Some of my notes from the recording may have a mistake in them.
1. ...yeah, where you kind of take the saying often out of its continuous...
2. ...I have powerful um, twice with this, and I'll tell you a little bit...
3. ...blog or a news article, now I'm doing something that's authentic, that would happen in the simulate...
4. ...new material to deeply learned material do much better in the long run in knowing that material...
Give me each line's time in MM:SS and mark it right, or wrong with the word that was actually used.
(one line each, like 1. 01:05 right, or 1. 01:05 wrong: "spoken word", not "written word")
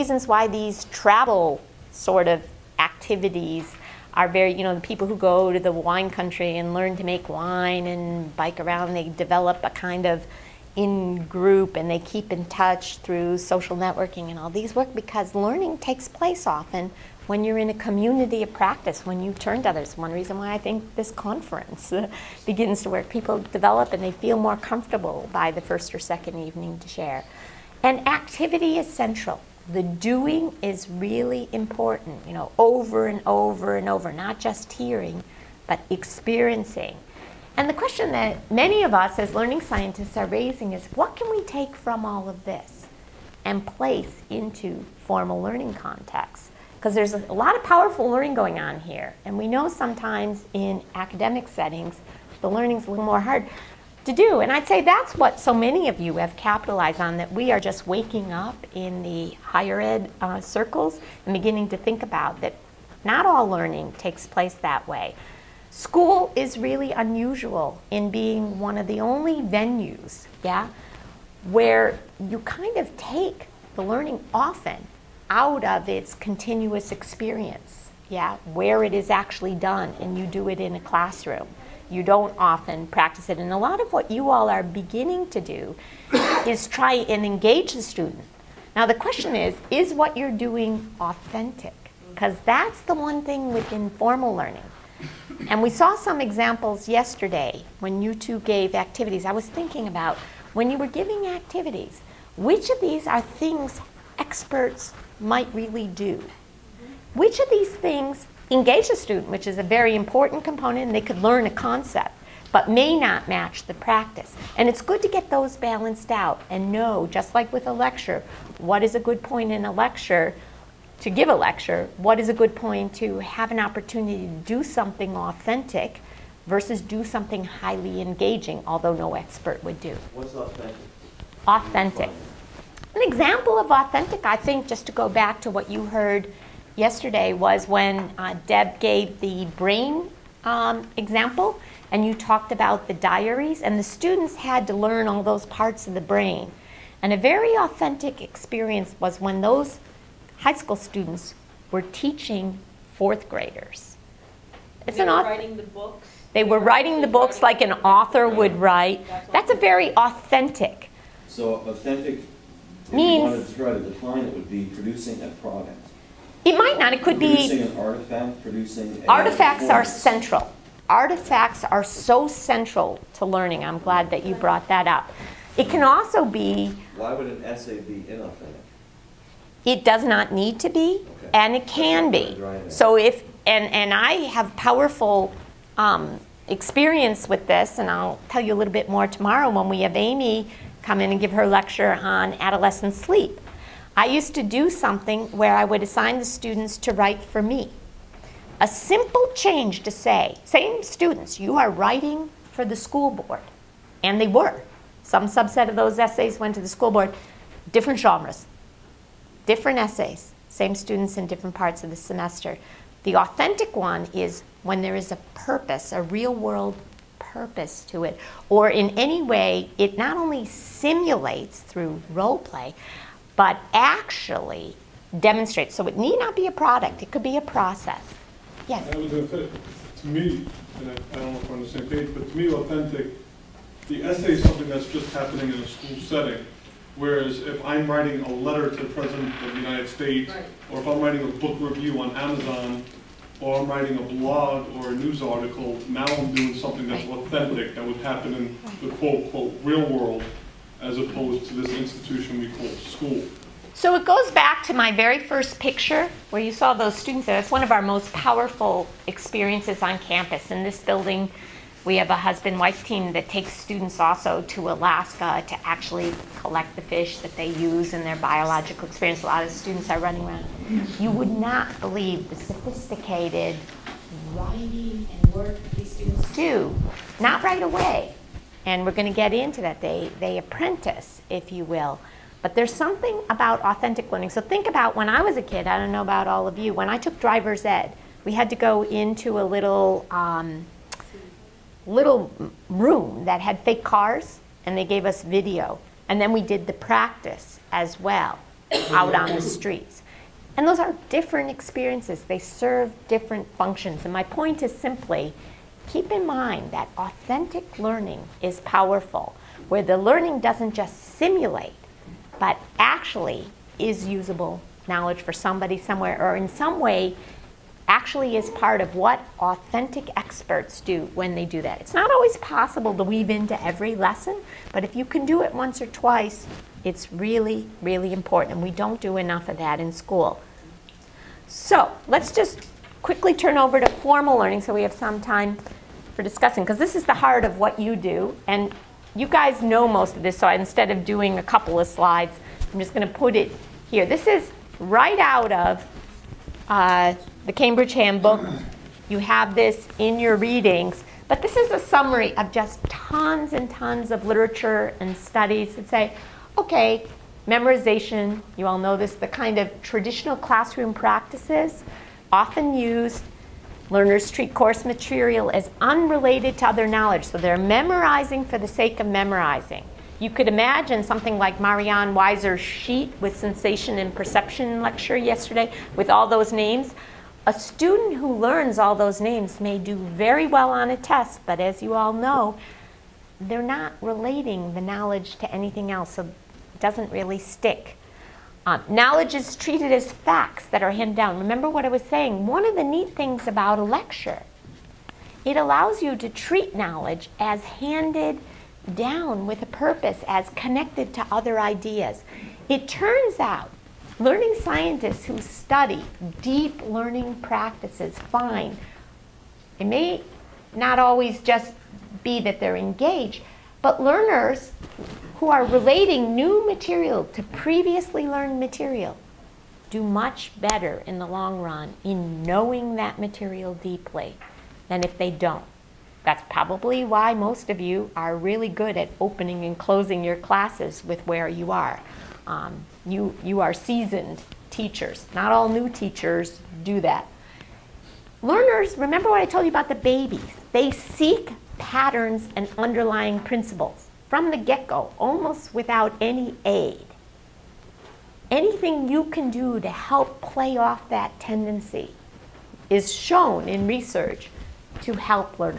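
1. 01:10 wrong: "learning", not "saying"
2. 03:03 wrong: "experience", not "twice"
3. 04:04 wrong: "quote", not "simulate"
4. 06:56 wrong: "previously", not "deeply".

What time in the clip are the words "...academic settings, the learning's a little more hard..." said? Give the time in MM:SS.
00:50.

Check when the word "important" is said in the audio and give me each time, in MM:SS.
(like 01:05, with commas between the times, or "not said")
00:31, 01:49, 05:28.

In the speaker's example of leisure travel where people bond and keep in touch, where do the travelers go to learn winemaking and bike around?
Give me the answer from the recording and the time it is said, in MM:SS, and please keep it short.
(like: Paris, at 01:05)
wine country, at 00:05.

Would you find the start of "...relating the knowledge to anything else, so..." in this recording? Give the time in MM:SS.
06:24.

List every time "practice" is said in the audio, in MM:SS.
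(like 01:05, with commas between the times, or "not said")
00:18, 01:22, 01:53, 04:56, 06:00, 06:47.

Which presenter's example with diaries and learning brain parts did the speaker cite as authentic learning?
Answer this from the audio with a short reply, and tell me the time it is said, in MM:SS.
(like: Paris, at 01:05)
Deb, at 02:18.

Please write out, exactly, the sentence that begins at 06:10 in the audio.
You could imagine something like Marianne Weiser's sheet with sensation and perception lecture yesterday with all those names.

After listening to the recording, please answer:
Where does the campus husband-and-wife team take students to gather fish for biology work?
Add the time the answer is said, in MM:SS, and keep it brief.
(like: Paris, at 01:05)
Alaska, at 04:24.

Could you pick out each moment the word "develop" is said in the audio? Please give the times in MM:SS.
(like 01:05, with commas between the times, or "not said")
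00:09, 00:23.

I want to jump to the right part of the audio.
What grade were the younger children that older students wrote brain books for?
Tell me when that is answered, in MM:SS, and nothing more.
02:32.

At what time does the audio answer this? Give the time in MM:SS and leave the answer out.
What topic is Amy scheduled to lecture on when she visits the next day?
03:12.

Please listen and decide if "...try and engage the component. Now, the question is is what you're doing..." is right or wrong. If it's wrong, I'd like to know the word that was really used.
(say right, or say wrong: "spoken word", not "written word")
wrong: "student", not "component".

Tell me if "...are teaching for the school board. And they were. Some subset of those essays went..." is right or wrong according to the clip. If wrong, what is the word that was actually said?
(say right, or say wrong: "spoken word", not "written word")
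wrong: "writing", not "teaching".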